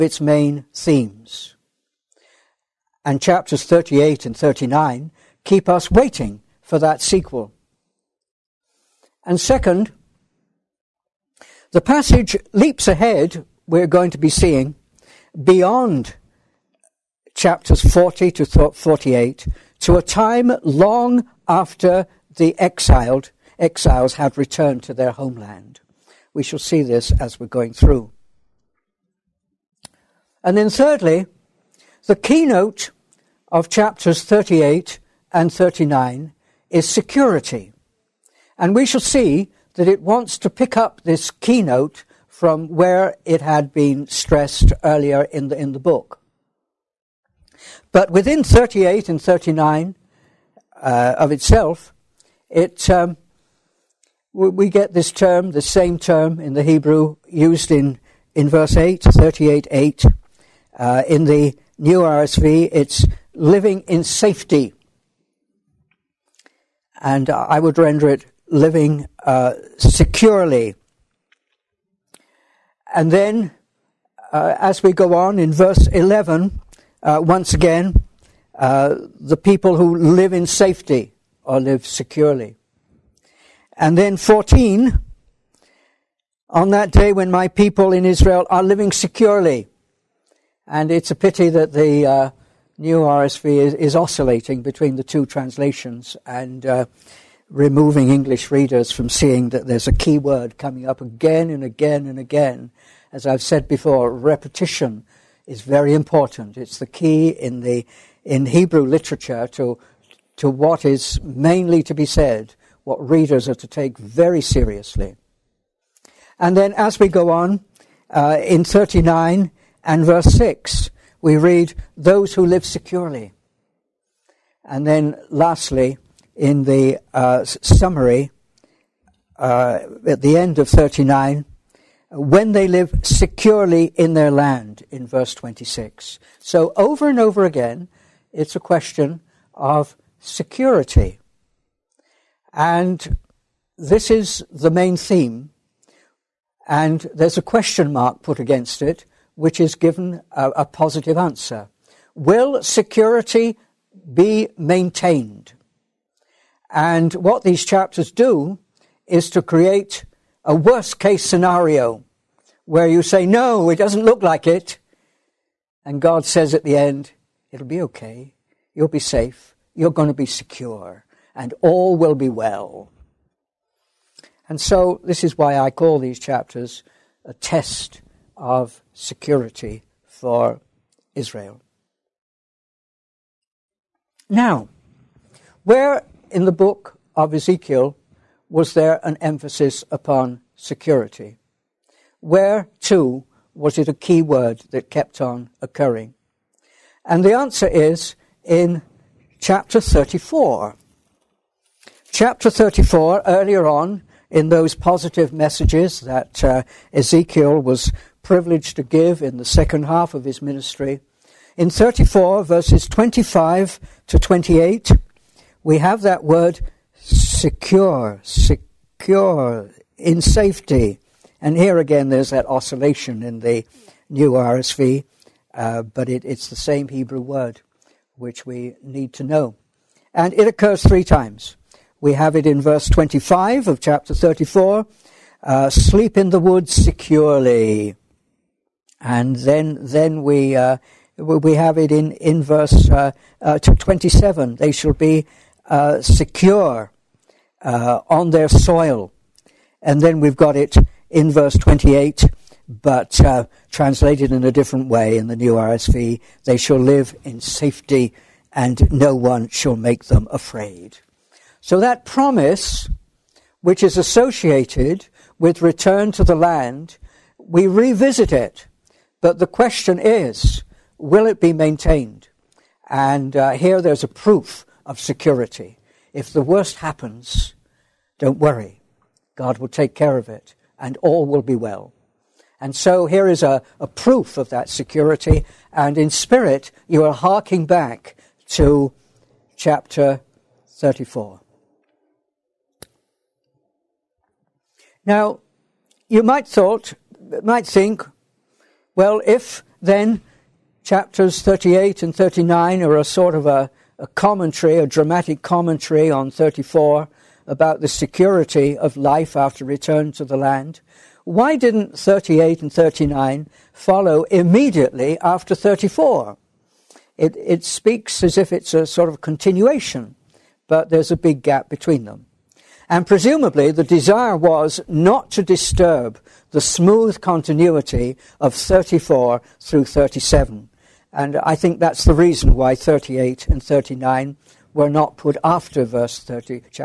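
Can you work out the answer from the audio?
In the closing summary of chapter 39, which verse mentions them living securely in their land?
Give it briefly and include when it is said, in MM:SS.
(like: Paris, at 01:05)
Verse 26, at 02:15.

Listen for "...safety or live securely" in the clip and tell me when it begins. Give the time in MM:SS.
01:20.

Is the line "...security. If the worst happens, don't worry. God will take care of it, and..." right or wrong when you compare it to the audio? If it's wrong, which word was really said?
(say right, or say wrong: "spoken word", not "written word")
right.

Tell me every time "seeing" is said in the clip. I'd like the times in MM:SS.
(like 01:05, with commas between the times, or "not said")
00:14, 01:39.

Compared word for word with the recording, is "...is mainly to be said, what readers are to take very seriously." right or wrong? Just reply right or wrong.
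right.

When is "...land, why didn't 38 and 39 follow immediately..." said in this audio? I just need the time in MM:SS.
05:10.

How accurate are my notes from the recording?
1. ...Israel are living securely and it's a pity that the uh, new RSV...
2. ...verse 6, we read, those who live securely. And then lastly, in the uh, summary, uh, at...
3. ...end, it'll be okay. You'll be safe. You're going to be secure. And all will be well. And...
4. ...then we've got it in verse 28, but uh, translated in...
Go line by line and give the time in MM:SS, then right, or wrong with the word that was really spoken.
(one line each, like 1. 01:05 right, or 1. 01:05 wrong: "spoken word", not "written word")
1. 01:28 right
2. 02:00 right
3. 02:46 right
4. 04:10 right.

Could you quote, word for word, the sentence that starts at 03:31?
In 34, verses 25 to 28, we have that word secure, secure, in safety.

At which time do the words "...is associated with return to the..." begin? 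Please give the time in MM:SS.
04:23.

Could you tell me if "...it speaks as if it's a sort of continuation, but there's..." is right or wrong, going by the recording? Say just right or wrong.
right.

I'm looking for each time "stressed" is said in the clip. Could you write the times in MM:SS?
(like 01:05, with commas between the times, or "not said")
00:44.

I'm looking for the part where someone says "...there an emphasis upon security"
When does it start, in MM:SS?
03:08.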